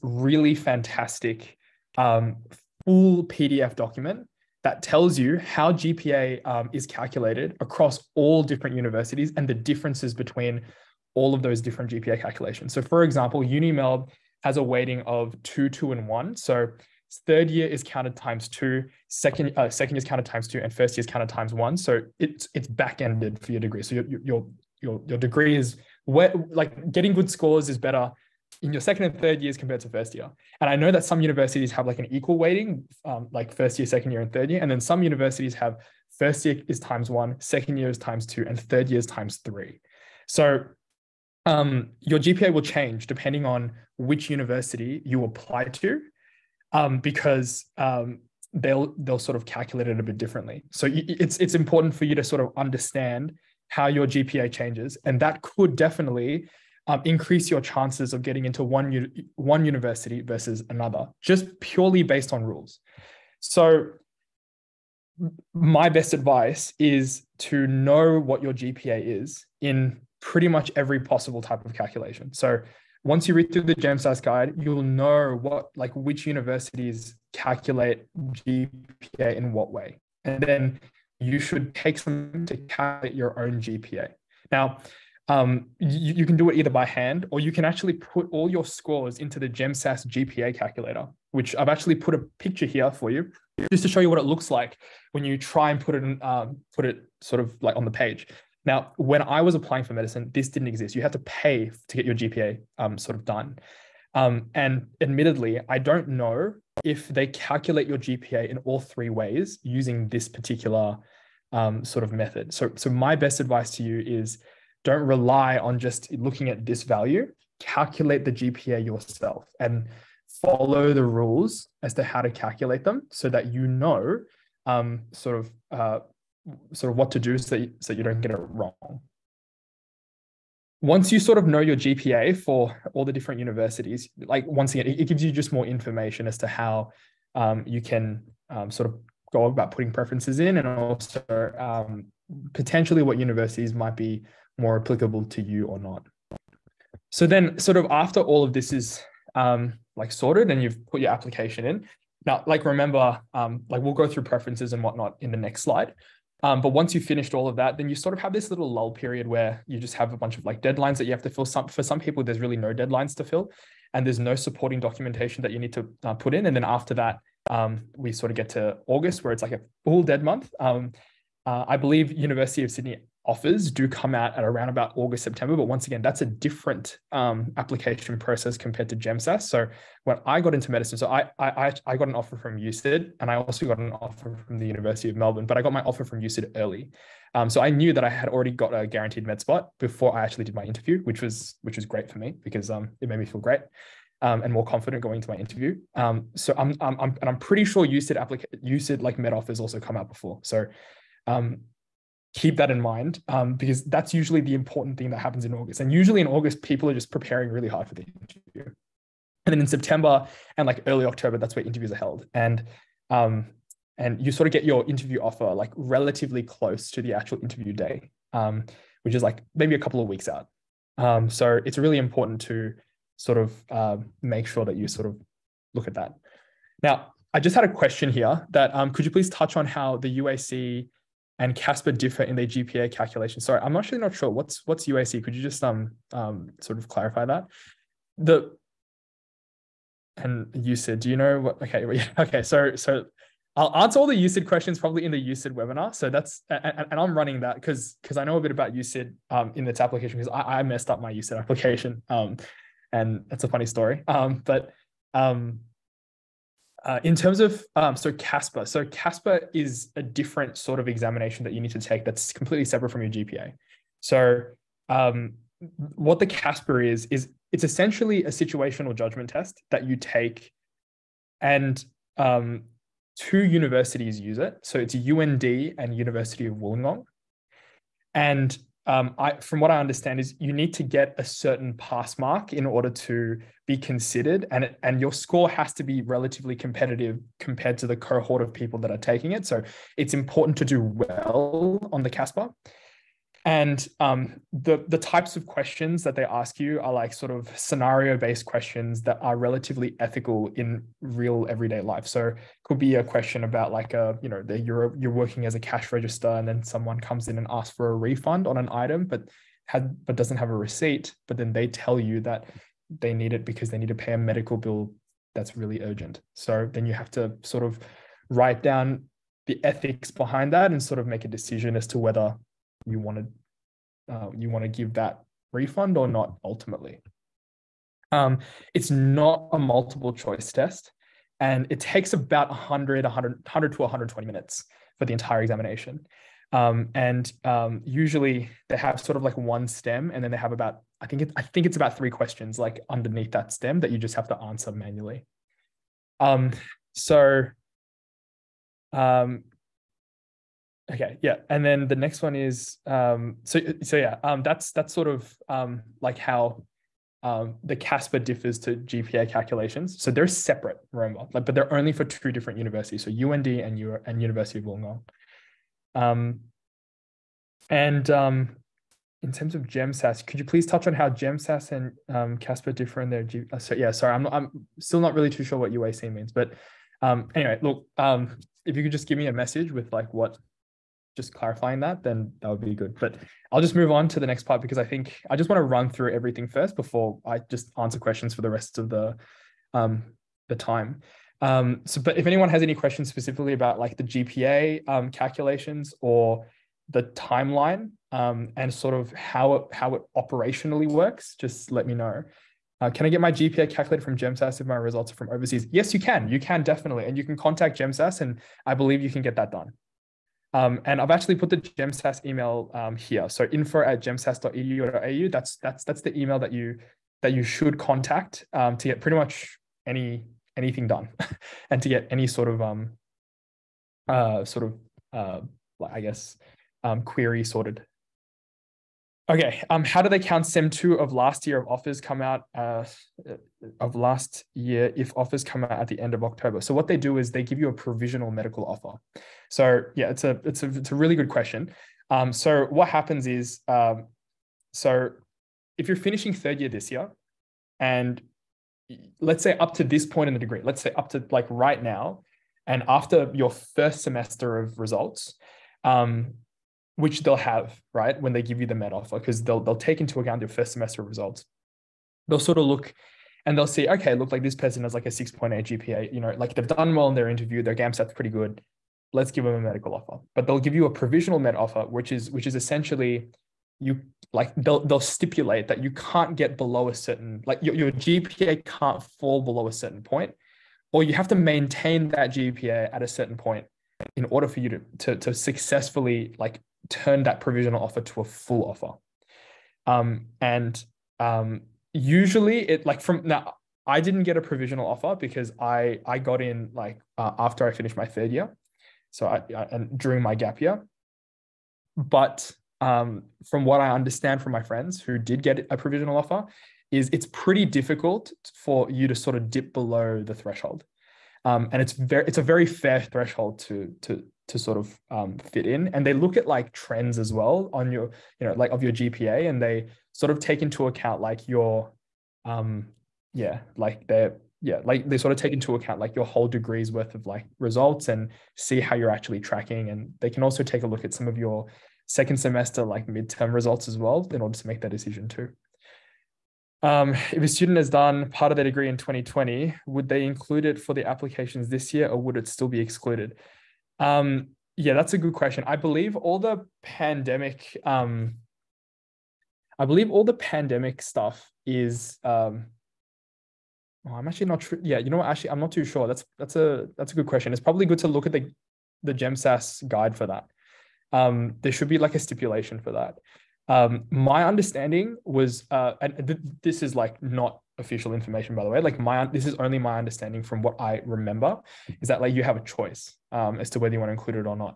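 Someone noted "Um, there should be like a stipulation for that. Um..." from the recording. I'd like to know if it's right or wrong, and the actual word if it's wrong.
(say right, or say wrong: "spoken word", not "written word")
right.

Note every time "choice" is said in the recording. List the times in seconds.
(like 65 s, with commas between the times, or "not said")
330 s, 572 s.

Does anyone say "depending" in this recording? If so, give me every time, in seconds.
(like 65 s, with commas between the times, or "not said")
43 s.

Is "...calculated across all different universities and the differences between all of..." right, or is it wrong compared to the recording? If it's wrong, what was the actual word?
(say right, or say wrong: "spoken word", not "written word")
right.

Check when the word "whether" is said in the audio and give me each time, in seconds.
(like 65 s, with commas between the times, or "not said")
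321 s, 573 s.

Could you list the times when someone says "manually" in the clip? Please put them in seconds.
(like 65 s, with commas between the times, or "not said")
344 s.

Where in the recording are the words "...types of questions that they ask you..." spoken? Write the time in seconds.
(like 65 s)
294 s.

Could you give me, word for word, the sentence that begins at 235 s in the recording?
Could you just um um sort of clarify that?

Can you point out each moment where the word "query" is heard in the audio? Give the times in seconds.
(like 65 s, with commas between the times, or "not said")
427 s.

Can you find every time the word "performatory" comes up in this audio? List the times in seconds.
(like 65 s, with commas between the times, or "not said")
not said.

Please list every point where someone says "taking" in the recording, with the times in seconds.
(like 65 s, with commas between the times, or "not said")
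288 s.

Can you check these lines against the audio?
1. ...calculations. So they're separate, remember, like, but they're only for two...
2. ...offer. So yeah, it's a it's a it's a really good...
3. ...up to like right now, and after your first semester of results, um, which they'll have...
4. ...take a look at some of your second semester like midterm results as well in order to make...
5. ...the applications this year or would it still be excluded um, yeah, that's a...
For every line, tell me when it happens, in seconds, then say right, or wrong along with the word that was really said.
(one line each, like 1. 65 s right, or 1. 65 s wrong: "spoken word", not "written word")
1. 359 s right
2. 438 s right
3. 450 s right
4. 530 s right
5. 540 s right.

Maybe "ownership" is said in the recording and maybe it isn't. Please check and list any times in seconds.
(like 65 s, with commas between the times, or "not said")
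not said.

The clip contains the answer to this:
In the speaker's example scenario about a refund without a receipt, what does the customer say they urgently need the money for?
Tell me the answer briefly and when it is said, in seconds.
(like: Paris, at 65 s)
a medical bill, at 314 s.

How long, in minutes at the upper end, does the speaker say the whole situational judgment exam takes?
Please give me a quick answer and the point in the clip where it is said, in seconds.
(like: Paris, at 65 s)
120, at 333 s.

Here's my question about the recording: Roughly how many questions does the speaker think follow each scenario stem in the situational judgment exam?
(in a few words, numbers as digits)
3.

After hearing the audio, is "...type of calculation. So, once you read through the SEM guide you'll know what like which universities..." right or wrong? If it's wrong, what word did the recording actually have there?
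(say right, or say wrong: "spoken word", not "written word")
wrong: "GemSAS", not "SEM".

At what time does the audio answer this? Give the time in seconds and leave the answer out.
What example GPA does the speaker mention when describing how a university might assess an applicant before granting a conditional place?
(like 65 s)
465 s.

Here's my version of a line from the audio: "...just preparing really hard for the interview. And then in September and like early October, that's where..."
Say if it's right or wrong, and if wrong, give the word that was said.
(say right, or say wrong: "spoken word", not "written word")
right.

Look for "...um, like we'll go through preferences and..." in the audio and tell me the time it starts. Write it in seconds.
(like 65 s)
153 s.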